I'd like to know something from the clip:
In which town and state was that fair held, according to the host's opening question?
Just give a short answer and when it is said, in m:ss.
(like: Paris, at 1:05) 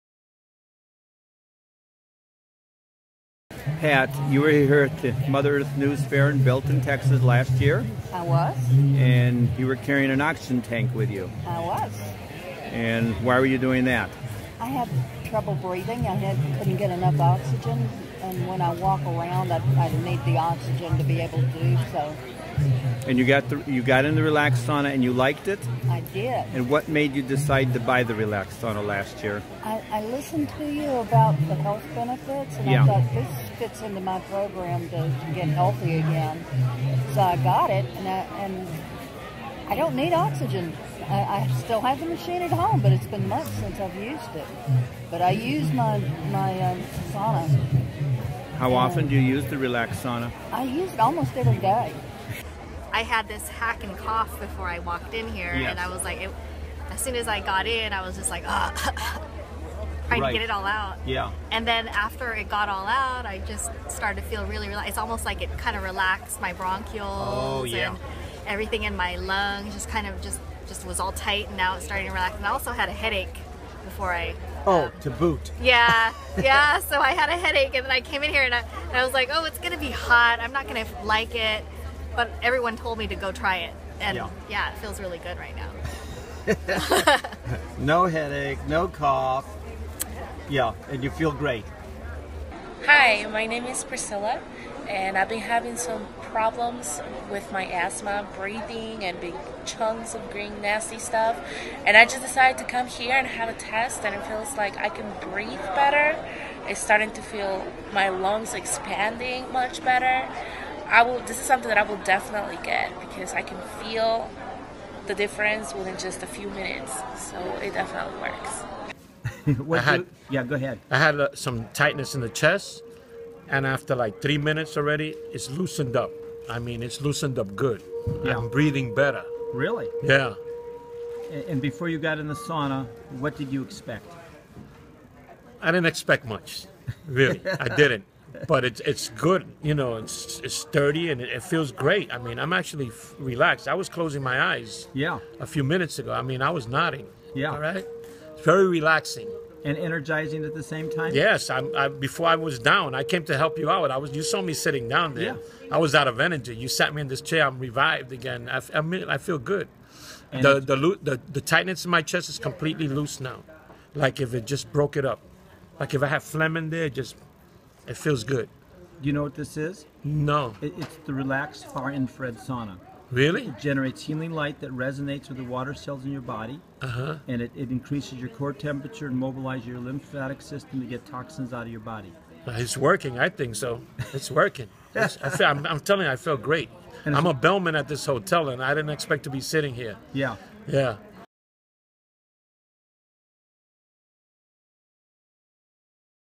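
Belton, Texas, at 0:06.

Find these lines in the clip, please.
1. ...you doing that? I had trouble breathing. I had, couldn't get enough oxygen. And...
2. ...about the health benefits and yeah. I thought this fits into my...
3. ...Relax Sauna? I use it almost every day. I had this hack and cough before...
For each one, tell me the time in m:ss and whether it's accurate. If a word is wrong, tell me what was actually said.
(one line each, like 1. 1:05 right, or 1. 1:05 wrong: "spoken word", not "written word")
1. 0:13 right
2. 0:30 right
3. 0:49 right.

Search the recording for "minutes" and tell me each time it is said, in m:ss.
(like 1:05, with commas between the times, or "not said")
1:56, 2:04, 2:25.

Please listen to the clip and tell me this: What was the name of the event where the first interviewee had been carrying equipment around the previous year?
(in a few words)
Mother Earth News Fair.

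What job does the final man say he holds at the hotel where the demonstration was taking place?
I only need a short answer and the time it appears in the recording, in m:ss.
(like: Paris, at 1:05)
Bellman, at 3:07.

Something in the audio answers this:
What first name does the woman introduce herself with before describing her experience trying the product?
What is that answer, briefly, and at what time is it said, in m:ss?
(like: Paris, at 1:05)
Priscilla, at 1:33.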